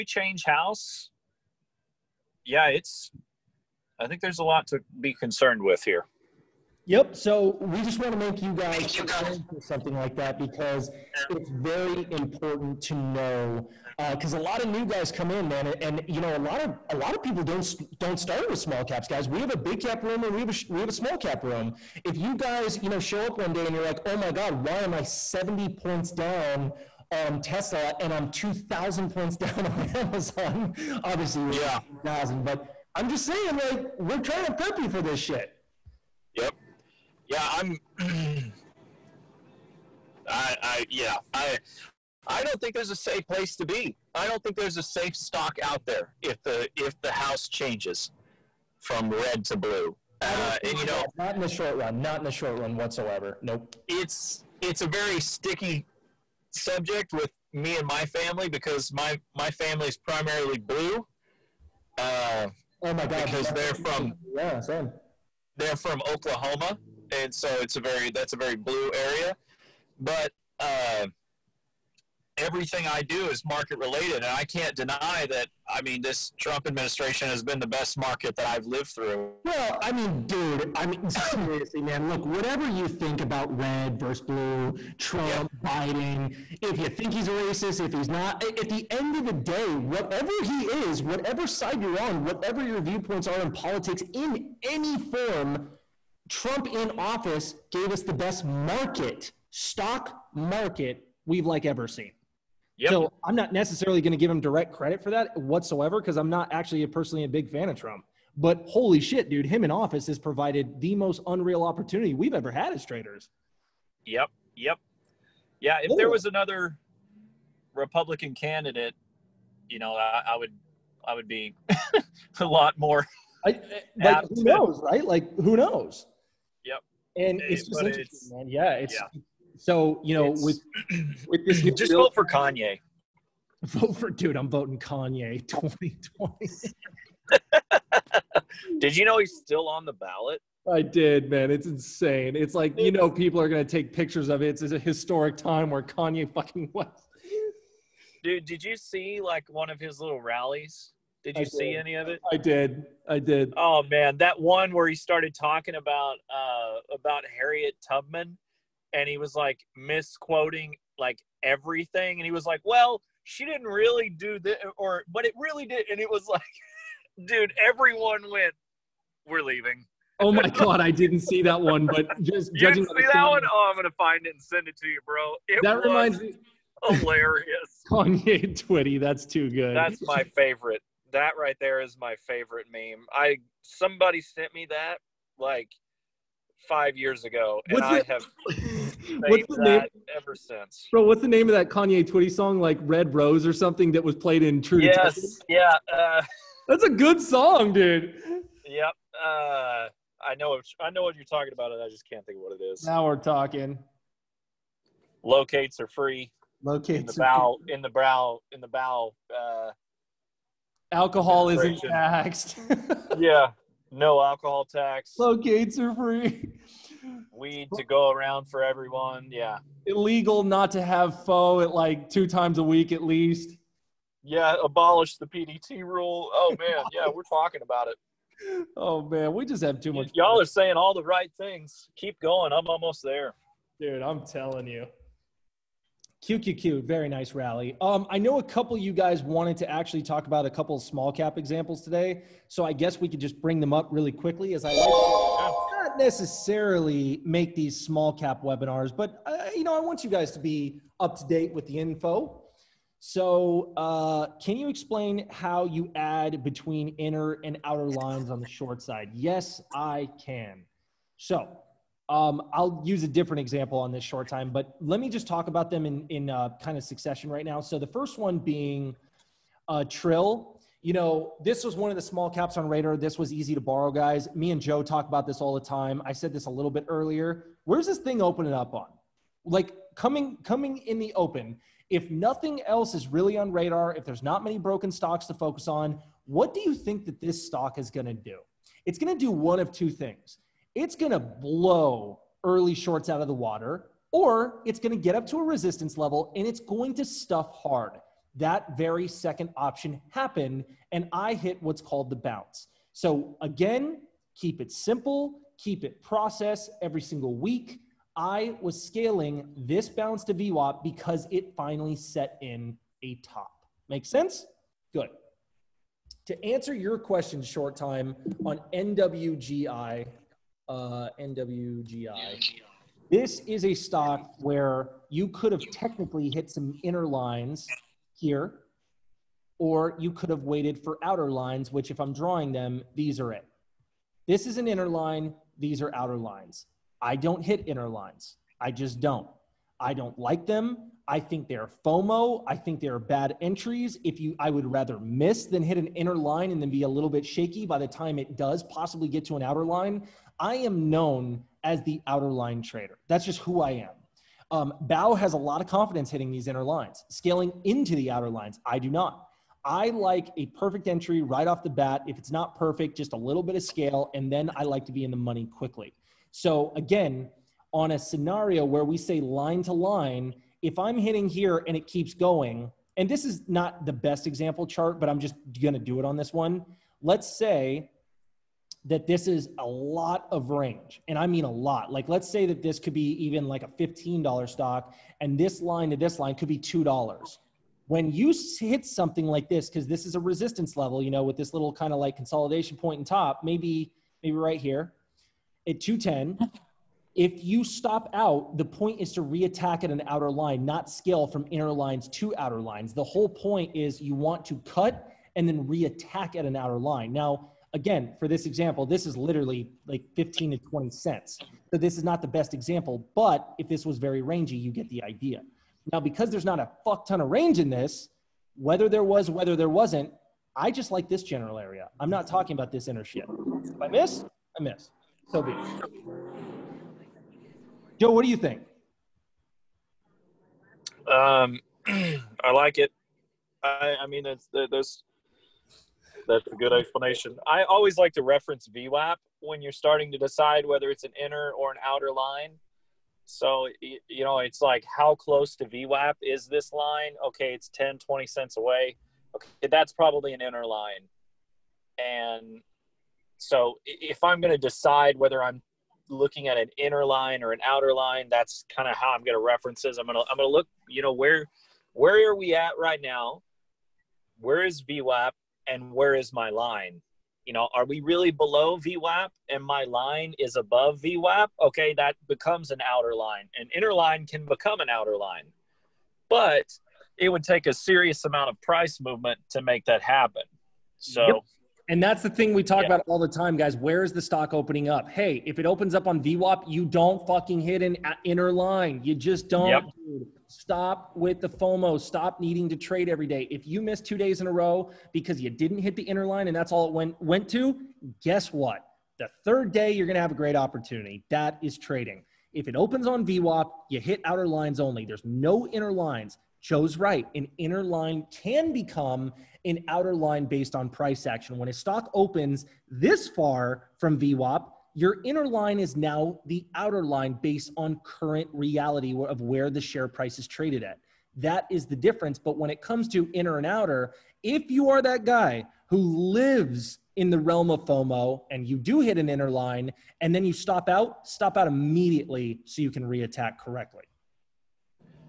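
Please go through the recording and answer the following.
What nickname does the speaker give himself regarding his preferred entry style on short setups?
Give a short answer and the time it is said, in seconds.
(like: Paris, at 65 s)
the outer line trader, at 352 s.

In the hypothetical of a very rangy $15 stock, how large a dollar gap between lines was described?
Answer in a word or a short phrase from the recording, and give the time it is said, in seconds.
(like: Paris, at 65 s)
$2, at 386 s.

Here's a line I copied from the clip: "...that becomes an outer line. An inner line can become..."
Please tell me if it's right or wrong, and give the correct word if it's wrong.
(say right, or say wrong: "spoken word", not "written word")
right.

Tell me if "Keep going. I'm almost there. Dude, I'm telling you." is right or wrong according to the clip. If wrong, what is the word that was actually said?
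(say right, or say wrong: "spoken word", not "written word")
right.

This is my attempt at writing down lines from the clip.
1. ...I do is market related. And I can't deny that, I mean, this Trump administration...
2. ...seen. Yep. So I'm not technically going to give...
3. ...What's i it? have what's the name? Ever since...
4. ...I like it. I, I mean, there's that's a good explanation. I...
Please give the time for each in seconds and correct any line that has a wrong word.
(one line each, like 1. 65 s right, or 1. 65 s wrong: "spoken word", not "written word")
1. 72 s right
2. 101 s wrong: "necessarily", not "technically"
3. 187 s right
4. 431 s right.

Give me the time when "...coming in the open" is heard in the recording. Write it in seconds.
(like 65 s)
280 s.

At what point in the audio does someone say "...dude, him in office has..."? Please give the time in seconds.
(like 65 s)
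109 s.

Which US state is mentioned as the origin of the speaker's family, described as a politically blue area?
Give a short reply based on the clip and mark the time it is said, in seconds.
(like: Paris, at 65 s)
Oklahoma, at 66 s.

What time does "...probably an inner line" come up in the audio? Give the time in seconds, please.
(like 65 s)
449 s.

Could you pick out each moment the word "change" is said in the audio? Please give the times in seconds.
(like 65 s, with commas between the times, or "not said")
0 s, 47 s.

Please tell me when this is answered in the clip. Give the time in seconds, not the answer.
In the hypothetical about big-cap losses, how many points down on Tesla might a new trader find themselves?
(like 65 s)
25 s.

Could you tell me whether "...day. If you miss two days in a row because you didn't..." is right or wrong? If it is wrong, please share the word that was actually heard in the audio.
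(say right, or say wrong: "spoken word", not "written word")
right.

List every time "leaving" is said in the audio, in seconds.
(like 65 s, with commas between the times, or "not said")
169 s.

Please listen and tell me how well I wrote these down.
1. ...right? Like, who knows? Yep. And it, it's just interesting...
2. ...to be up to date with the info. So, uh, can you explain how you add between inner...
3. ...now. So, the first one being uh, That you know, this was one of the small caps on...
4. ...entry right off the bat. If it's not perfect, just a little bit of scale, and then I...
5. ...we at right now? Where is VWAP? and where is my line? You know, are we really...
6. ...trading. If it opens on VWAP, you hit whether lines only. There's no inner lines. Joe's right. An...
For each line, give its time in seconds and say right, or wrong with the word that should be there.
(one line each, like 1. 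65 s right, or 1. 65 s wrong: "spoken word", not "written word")
1. 124 s right
2. 250 s right
3. 267 s wrong: "Trill", not "That"
4. 360 s right
5. 462 s right
6. 501 s wrong: "outer", not "whether".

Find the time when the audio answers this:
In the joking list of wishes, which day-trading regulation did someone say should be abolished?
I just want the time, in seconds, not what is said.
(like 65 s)
225 s.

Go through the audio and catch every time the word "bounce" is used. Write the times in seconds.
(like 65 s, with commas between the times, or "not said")
302 s, 309 s.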